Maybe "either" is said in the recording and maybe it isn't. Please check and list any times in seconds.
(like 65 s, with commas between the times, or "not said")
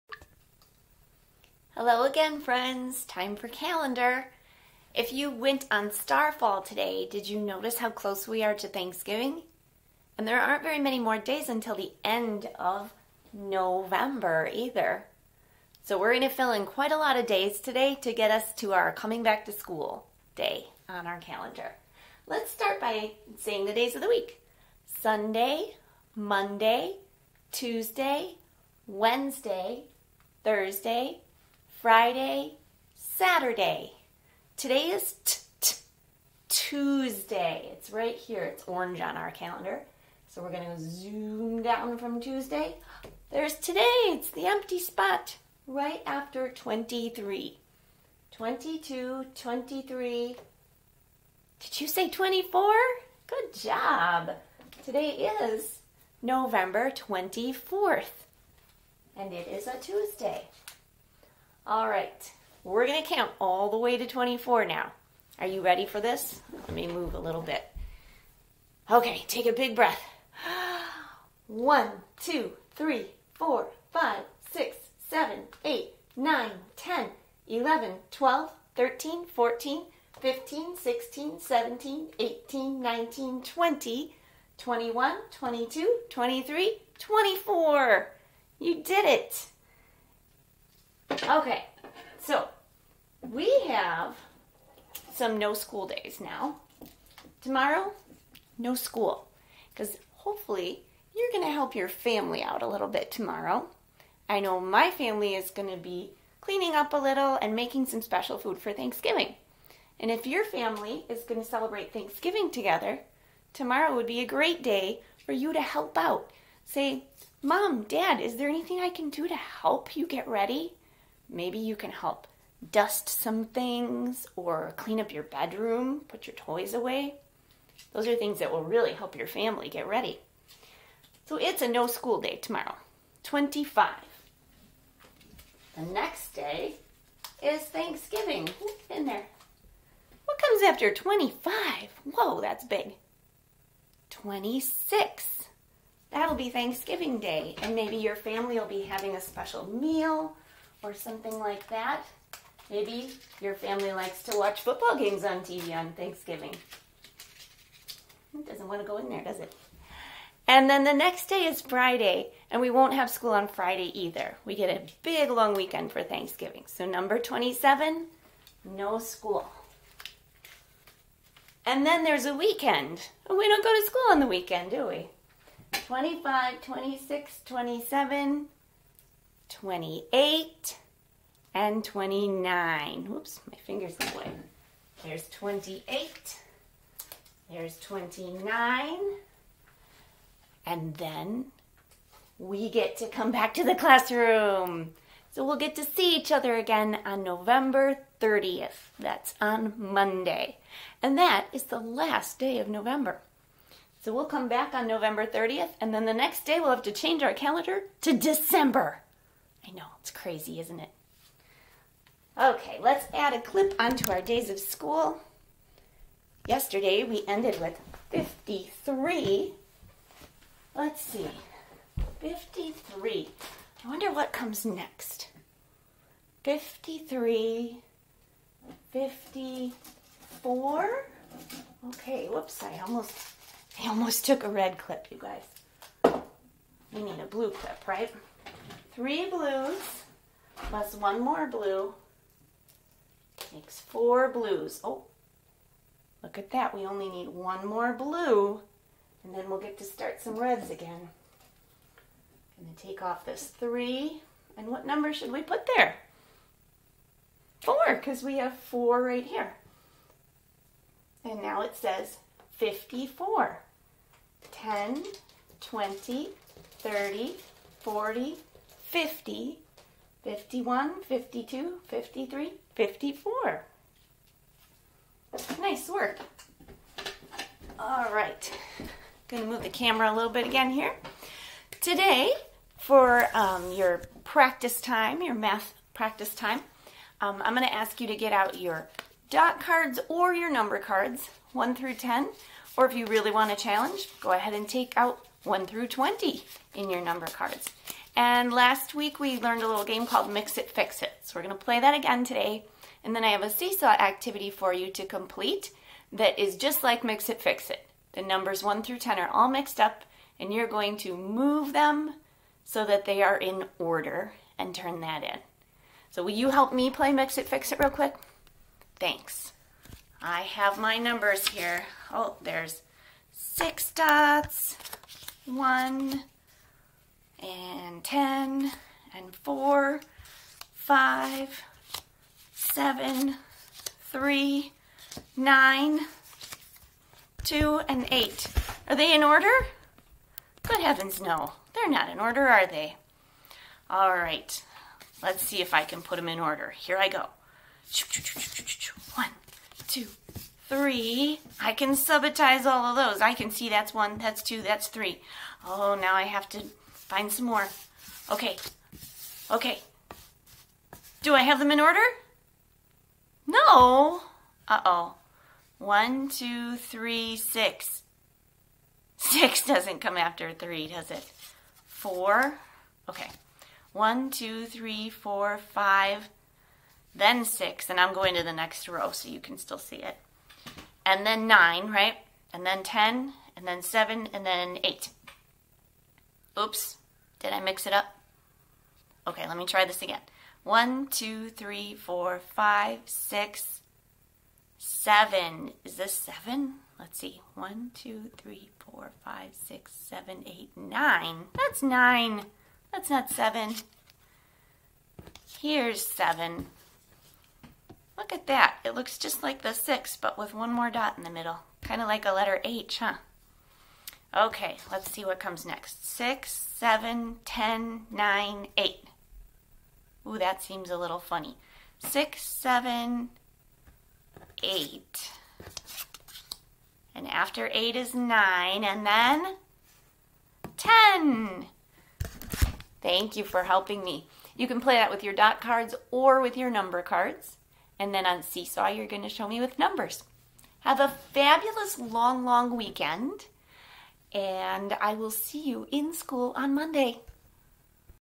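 14 s, 163 s.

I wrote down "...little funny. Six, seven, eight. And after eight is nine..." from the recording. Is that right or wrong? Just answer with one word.
right.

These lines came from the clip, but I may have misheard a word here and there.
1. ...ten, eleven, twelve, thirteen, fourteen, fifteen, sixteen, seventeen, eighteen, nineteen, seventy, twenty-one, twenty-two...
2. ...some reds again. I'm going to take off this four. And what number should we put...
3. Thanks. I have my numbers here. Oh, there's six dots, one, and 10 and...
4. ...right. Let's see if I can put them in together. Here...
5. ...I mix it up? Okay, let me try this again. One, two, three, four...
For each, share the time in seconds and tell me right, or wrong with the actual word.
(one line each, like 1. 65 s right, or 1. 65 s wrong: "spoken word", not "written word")
1. 76 s wrong: "twenty", not "seventy"
2. 250 s wrong: "three", not "four"
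3. 318 s right
4. 344 s wrong: "order", not "together"
5. 387 s right.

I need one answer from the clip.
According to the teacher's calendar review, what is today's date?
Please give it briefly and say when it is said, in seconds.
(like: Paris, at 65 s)
November 24th, at 56 s.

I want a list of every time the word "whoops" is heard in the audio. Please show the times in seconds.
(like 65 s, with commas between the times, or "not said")
183 s, 232 s.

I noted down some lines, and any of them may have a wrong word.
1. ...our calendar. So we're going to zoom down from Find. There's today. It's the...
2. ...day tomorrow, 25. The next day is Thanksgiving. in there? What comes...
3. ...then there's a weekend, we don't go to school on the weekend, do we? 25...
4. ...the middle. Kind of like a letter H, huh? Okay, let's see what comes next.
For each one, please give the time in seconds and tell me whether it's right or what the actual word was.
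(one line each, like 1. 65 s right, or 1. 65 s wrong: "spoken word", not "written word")
1. 39 s wrong: "Tuesday", not "Find"
2. 132 s right
3. 171 s right
4. 411 s right.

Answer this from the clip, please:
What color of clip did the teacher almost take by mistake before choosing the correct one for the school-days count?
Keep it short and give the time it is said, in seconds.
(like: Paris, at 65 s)
red, at 234 s.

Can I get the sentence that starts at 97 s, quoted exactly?
Tomorrow, no school, because hopefully you're going to help your family out a little bit tomorrow.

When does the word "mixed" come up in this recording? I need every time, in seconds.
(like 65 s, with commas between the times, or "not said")
309 s.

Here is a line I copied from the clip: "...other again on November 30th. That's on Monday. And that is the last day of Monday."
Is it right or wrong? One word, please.
wrong.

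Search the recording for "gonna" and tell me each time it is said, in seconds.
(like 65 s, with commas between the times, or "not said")
62 s, 279 s, 287 s.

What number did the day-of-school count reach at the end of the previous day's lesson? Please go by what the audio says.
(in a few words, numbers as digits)
53.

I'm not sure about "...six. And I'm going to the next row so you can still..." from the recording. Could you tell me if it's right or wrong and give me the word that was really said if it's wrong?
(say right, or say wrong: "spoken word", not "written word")
right.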